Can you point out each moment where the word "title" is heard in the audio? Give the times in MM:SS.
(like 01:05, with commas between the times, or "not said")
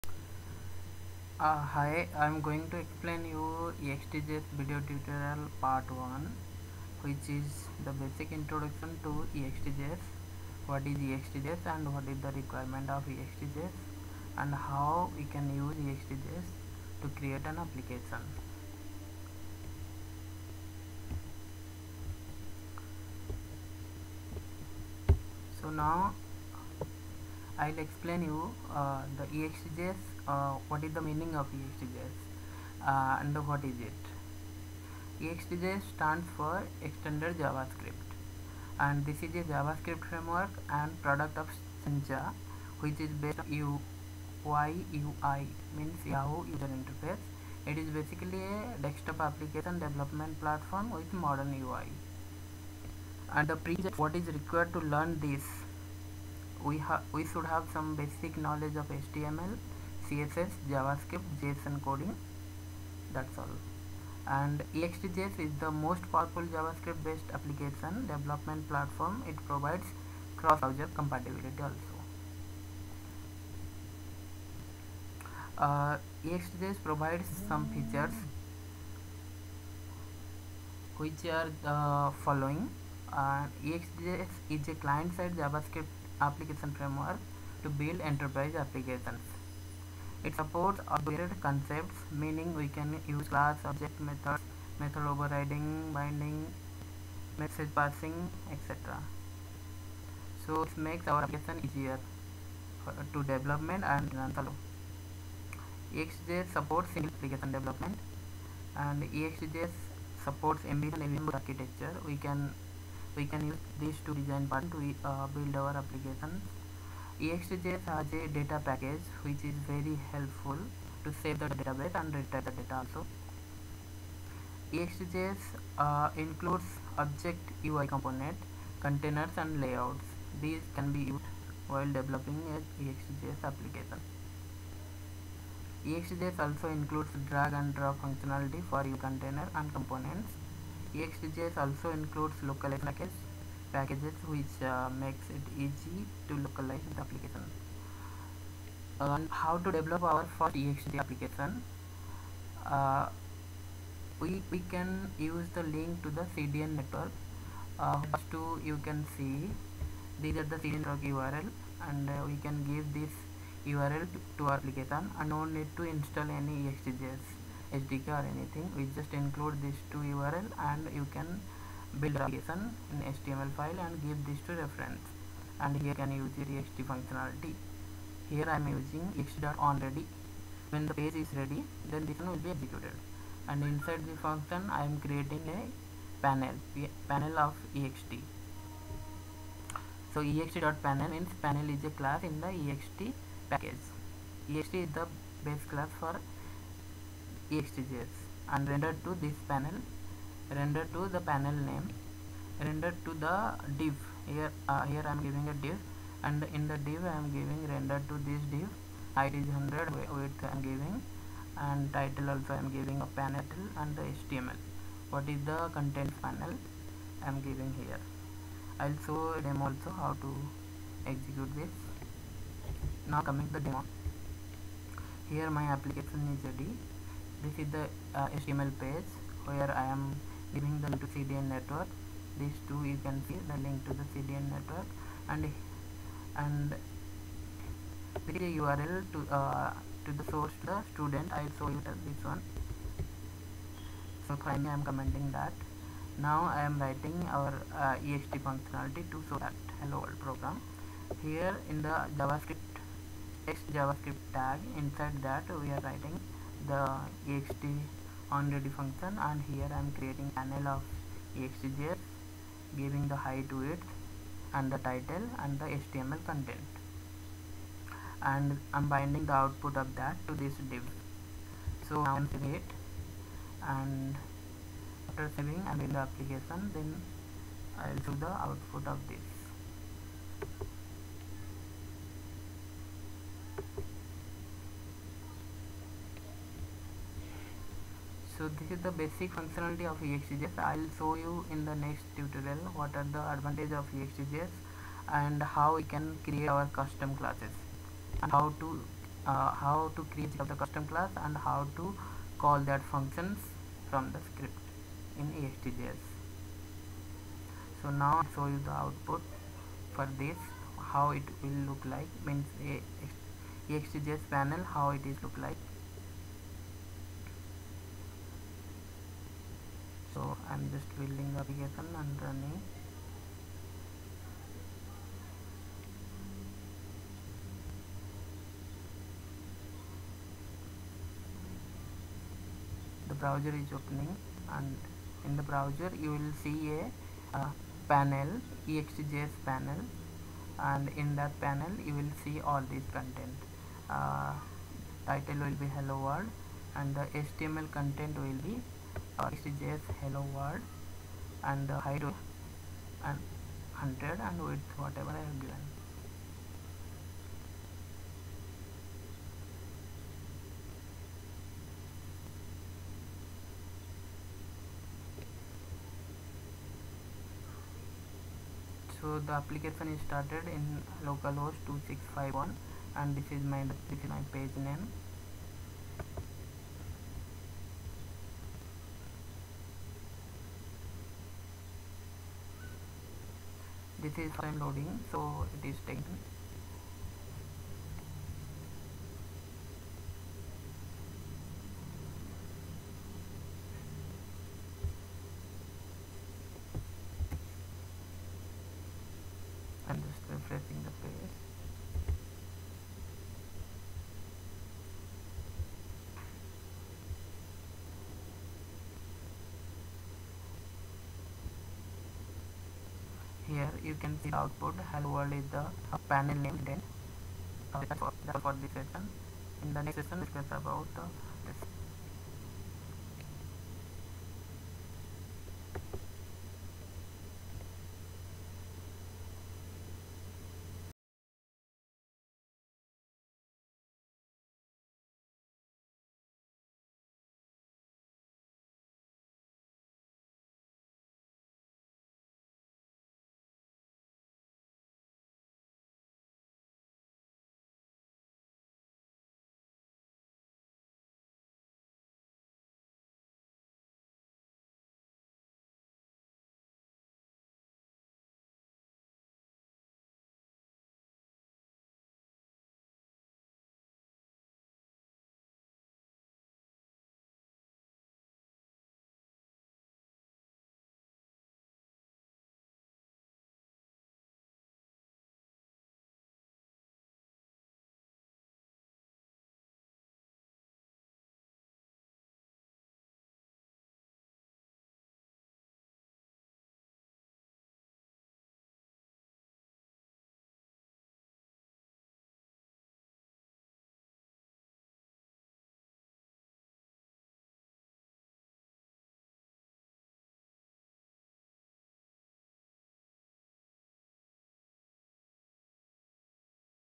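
03:31, 04:24, 05:45.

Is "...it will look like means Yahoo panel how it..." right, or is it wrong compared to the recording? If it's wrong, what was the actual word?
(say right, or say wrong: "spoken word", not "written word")
wrong: "EXTJS", not "Yahoo".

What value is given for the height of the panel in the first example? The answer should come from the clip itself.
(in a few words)
100.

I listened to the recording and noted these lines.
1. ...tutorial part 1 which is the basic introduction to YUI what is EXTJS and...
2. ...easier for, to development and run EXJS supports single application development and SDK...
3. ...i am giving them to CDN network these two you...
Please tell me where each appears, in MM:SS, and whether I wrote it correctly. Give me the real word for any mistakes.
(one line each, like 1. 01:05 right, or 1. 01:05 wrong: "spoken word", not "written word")
1. 00:04 wrong: "EXTJS", not "YUI"
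2. 01:41 wrong: "EXJS", not "SDK"
3. 03:49 right.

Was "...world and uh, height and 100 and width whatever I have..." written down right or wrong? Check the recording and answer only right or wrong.
right.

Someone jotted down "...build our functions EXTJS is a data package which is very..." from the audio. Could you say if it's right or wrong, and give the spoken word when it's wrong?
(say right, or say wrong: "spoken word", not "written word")
wrong: "applications", not "functions".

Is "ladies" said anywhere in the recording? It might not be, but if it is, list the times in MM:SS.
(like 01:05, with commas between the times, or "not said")
not said.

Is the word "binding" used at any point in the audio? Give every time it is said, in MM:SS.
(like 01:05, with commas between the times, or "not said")
01:35, 04:28.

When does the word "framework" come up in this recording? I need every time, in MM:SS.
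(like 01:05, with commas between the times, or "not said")
00:40, 01:26.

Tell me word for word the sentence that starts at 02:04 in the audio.
EXTJS uh, includes object UI component, containers and layouts.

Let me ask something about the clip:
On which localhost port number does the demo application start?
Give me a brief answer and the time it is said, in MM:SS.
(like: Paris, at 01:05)
2651, at 06:11.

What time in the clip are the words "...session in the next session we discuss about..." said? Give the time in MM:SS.
06:58.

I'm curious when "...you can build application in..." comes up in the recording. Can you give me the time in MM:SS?
02:50.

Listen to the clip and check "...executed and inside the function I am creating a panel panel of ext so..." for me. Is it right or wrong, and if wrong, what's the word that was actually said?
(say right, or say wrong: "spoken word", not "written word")
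right.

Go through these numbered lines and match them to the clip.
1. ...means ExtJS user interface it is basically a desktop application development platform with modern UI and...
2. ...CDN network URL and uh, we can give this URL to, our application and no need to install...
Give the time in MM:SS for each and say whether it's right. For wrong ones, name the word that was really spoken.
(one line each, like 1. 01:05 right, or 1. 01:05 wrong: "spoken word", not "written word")
1. 00:45 wrong: "Yahoo", not "ExtJS"
2. 02:40 right.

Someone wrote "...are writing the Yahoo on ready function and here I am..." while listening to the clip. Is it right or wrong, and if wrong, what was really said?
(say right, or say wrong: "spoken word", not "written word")
wrong: "Ext", not "Yahoo".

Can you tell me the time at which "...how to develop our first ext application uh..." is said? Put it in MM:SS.
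02:29.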